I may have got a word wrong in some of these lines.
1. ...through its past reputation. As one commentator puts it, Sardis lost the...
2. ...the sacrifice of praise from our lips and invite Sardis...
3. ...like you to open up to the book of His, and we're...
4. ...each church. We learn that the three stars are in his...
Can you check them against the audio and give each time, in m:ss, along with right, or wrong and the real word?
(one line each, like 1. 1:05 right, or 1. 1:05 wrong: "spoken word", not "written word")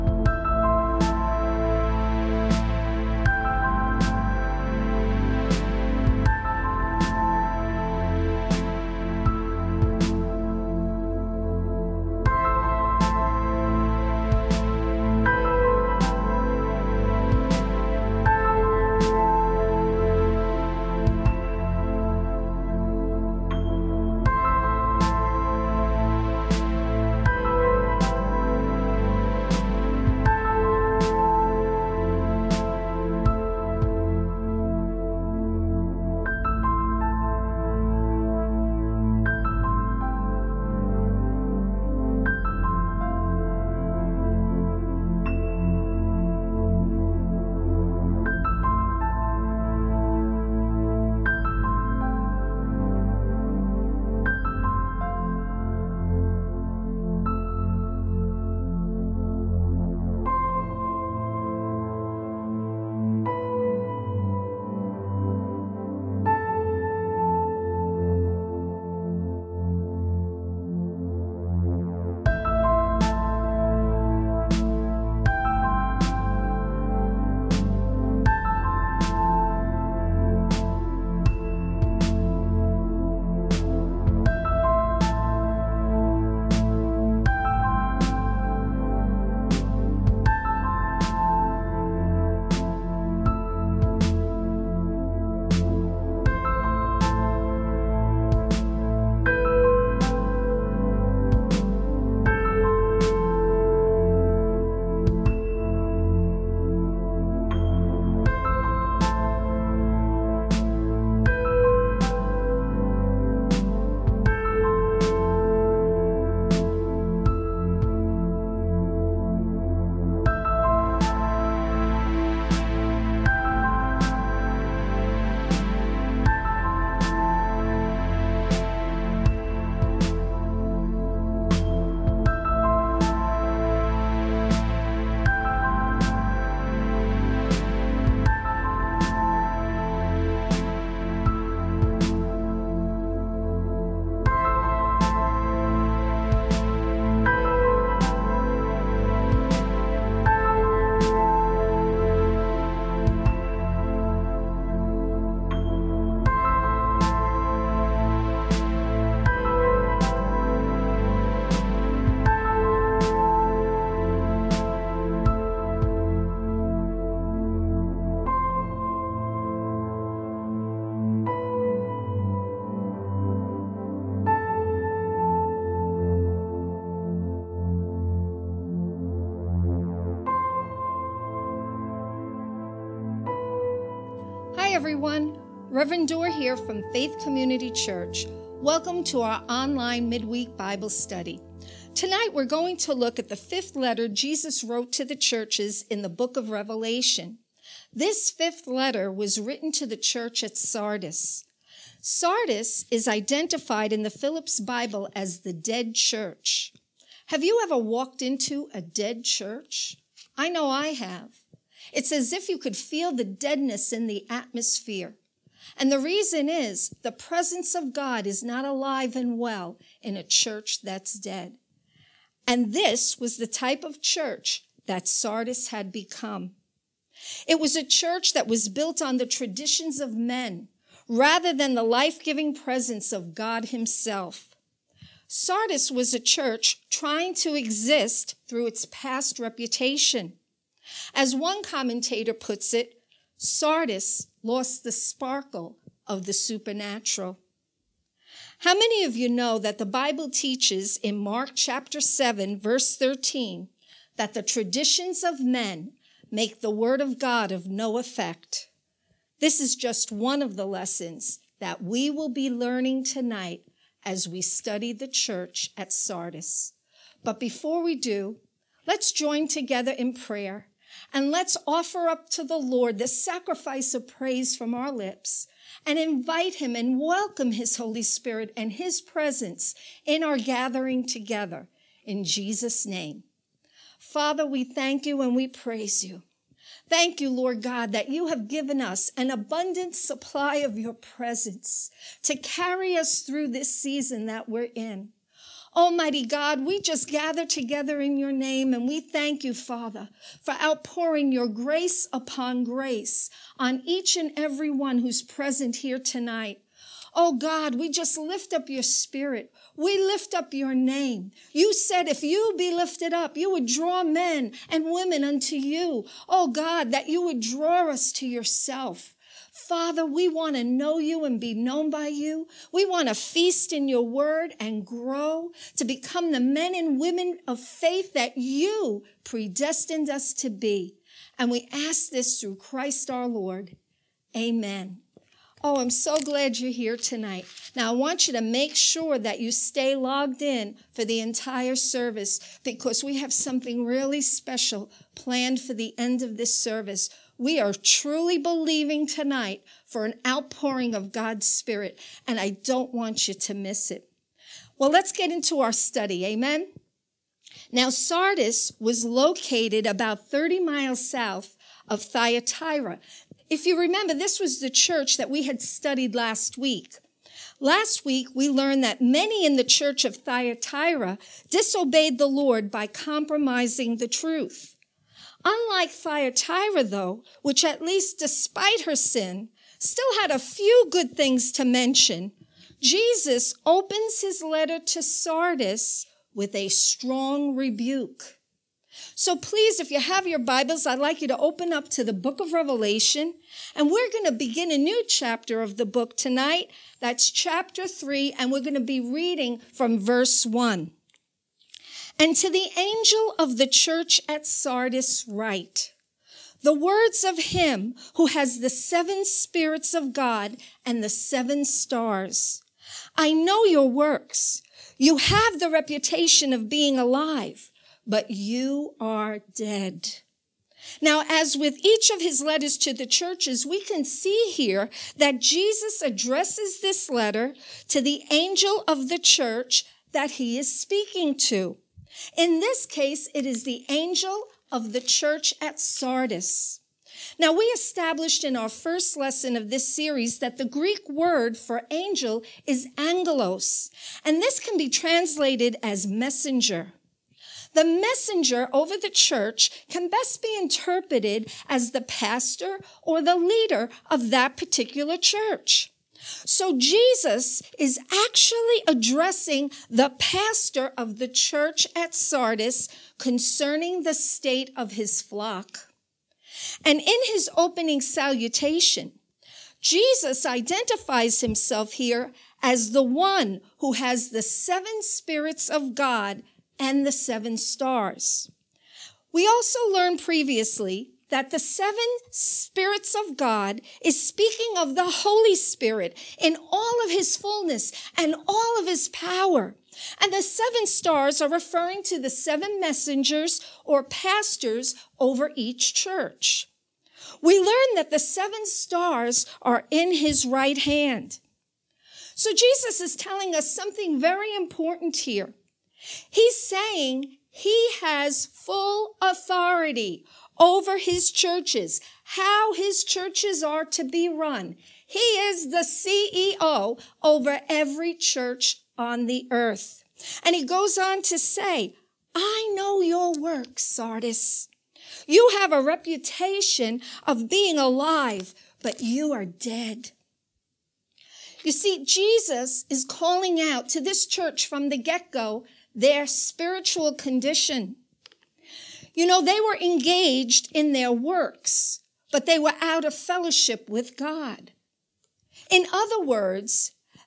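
1. 3:58 right
2. 4:32 wrong: "Him", not "Sardis"
3. 6:31 wrong: "Revelation", not "His"
4. 8:15 wrong: "seven", not "three".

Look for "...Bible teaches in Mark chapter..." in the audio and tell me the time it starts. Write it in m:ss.
4:09.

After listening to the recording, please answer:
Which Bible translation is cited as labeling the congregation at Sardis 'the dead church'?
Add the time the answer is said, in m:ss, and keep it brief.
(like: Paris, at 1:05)
Phillips Bible, at 3:24.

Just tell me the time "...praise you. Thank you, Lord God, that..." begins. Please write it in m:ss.
4:45.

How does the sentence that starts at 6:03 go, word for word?
If you remember, this was the church that we had studied last week.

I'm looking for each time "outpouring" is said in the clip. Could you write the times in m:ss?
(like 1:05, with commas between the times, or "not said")
5:00, 5:50.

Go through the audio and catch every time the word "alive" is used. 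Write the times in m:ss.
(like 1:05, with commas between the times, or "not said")
3:38, 6:56, 8:47.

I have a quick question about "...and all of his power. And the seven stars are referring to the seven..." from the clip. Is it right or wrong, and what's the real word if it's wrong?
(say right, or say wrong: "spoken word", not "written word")
right.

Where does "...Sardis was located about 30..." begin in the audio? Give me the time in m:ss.
5:57.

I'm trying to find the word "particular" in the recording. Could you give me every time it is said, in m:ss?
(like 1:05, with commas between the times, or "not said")
7:34.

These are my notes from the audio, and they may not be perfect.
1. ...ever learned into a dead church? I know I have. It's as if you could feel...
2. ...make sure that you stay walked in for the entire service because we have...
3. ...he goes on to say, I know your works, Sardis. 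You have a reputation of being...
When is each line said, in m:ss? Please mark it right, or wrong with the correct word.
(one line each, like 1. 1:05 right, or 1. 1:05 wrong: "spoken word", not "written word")
1. 3:27 wrong: "walked", not "learned"
2. 5:38 wrong: "logged", not "walked"
3. 8:40 right.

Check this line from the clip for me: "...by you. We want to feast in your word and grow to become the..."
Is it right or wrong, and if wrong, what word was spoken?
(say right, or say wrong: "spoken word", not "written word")
right.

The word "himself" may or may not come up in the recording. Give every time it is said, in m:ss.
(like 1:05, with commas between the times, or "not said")
3:53, 7:51.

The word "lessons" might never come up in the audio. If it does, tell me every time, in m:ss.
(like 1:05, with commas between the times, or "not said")
4:20, 7:19.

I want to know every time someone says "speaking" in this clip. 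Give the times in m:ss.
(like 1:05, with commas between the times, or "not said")
7:10, 8:04.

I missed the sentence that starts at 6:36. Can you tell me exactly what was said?
That's chapter three, and we're going to be reading from verse one.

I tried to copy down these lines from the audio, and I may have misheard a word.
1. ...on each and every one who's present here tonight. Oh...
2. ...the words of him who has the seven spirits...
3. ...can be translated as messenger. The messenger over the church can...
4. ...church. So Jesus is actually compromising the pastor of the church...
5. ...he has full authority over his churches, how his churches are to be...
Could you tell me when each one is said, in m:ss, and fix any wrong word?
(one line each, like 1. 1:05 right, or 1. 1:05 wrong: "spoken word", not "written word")
1. 5:03 right
2. 6:46 right
3. 7:24 right
4. 7:35 wrong: "addressing", not "compromising"
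5. 8:27 right.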